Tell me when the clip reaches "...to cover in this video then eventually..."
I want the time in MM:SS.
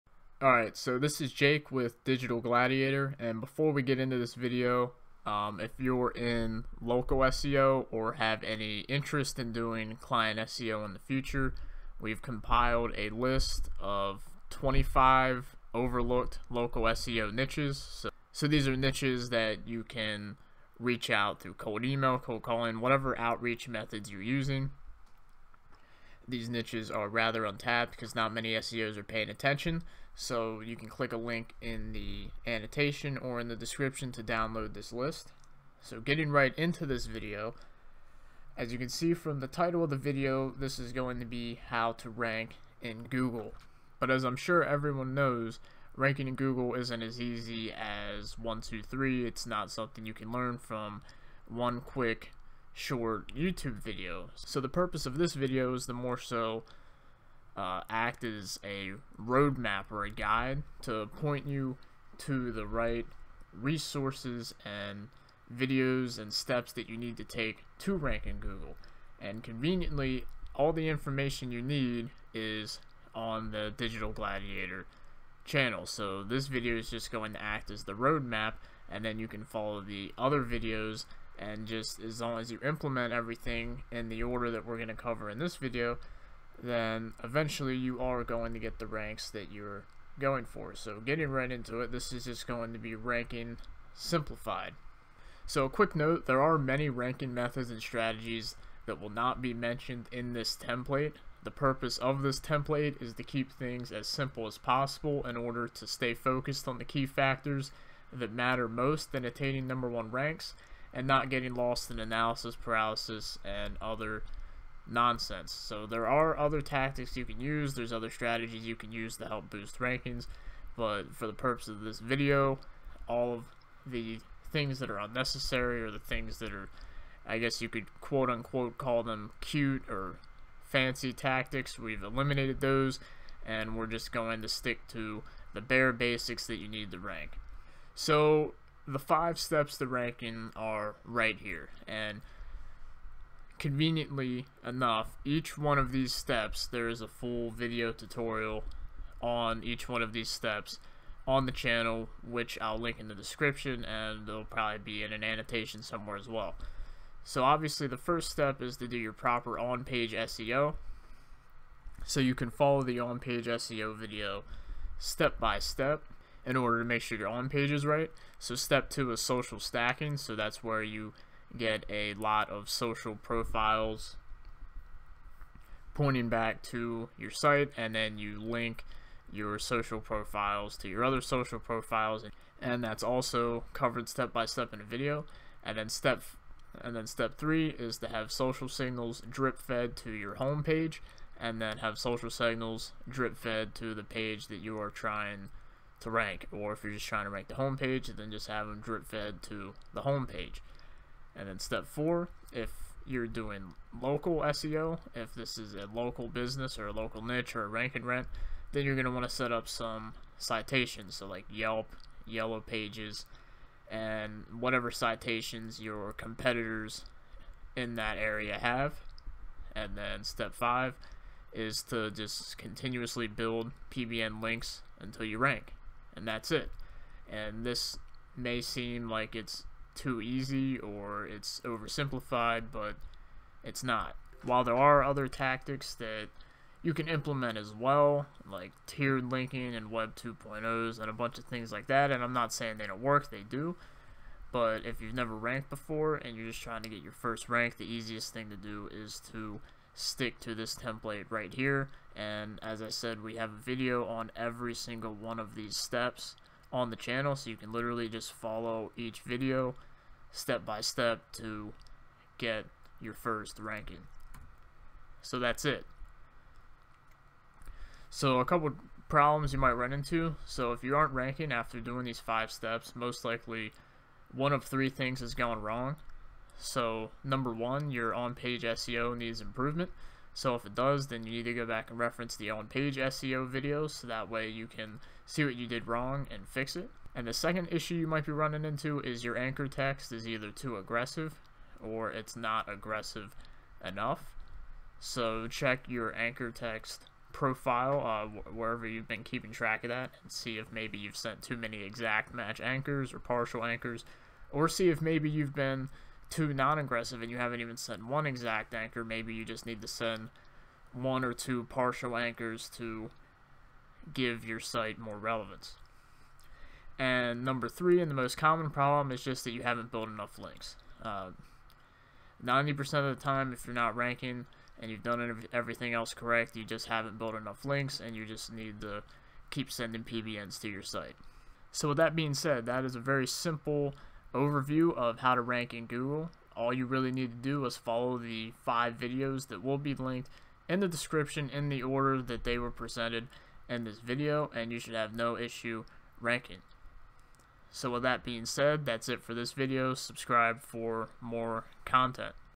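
01:24.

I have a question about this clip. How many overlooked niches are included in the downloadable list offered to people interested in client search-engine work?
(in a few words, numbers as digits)
25.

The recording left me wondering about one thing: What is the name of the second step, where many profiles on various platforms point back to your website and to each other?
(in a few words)
Social stacking.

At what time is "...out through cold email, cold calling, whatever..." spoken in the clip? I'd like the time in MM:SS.
00:21.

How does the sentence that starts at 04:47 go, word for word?
And the second issue you might be running into is your anchor text is either too aggressive or it's not aggressive enough.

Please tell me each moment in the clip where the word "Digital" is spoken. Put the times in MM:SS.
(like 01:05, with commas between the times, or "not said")
00:02, 01:13.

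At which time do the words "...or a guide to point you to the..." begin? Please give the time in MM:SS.
00:59.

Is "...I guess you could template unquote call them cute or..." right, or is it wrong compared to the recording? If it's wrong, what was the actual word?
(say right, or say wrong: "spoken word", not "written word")
wrong: "quote", not "template".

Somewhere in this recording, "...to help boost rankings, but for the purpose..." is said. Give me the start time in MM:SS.
01:59.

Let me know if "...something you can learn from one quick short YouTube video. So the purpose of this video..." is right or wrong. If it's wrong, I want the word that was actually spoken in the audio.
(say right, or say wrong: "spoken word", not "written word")
right.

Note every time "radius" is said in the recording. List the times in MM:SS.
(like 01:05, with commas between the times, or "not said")
not said.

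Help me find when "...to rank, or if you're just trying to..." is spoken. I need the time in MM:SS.
03:16.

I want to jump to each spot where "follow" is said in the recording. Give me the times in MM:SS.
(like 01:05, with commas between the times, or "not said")
01:19, 02:42, 04:18, 05:37.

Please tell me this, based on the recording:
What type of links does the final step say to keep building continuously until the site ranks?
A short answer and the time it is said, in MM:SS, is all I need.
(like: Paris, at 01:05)
PBN links, at 03:43.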